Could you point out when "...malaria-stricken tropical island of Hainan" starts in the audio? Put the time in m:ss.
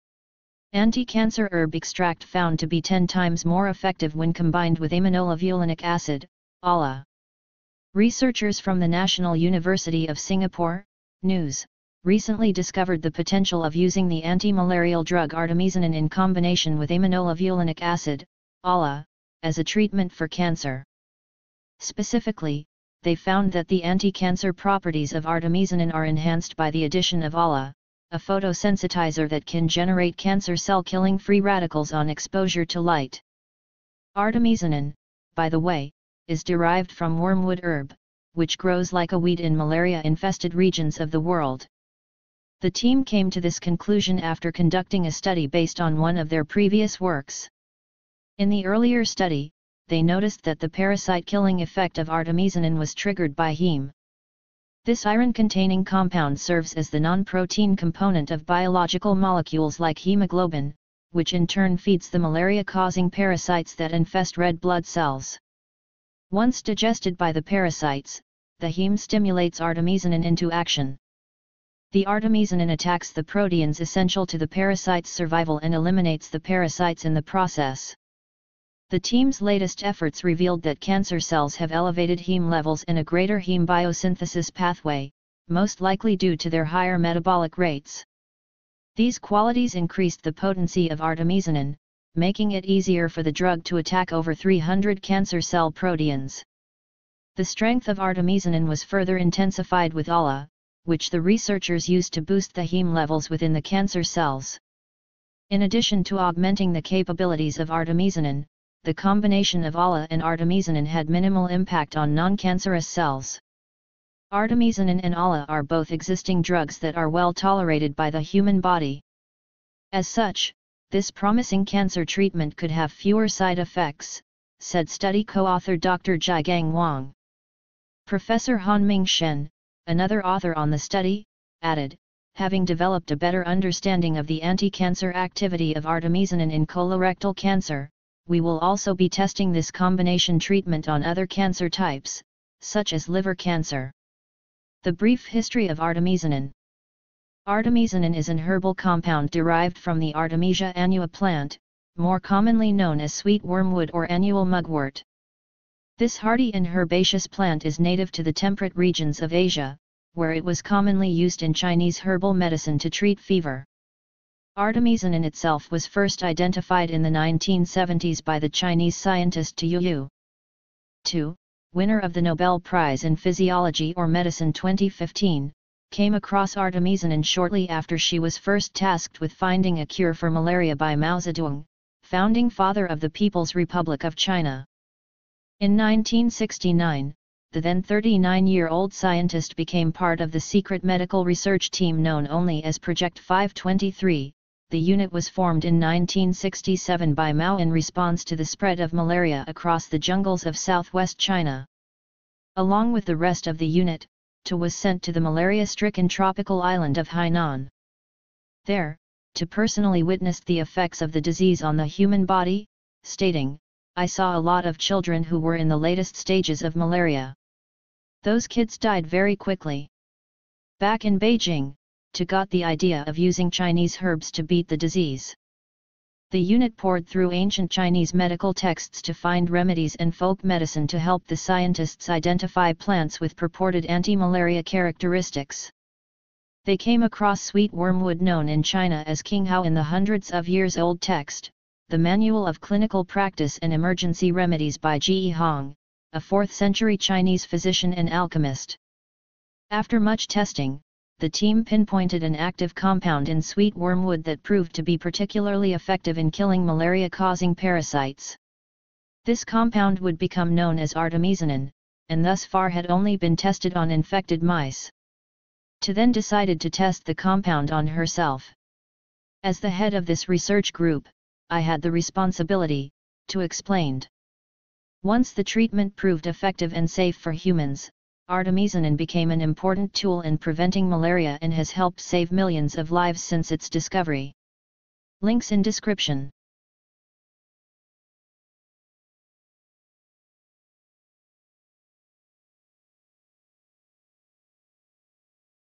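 3:25.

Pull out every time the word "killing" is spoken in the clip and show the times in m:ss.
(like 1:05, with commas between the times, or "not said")
0:30, 0:51, 4:16.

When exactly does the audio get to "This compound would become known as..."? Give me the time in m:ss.
4:19.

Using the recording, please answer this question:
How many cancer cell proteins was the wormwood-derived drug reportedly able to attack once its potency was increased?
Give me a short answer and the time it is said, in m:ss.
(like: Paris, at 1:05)
over 300, at 1:34.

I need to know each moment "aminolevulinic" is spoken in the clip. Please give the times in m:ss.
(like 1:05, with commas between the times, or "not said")
0:04, 0:16.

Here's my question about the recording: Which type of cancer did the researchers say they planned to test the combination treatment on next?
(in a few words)
liver cancer.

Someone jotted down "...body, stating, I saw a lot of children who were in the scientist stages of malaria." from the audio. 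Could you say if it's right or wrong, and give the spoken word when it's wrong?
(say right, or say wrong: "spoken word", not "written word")
wrong: "latest", not "scientist".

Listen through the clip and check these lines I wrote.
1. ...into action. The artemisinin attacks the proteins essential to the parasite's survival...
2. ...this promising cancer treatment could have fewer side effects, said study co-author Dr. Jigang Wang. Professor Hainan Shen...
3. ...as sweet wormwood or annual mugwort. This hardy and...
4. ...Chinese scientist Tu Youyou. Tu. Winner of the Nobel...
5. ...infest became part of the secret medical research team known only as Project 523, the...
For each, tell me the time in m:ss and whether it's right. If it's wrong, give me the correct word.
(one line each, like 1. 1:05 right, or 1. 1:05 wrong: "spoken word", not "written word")
1. 1:10 right
2. 2:00 wrong: "Hanming", not "Hainan"
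3. 2:33 right
4. 2:48 right
5. 3:08 wrong: "scientist", not "infest".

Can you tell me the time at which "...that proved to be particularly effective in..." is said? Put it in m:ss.
4:14.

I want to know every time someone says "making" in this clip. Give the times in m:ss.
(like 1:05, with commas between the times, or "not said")
1:32.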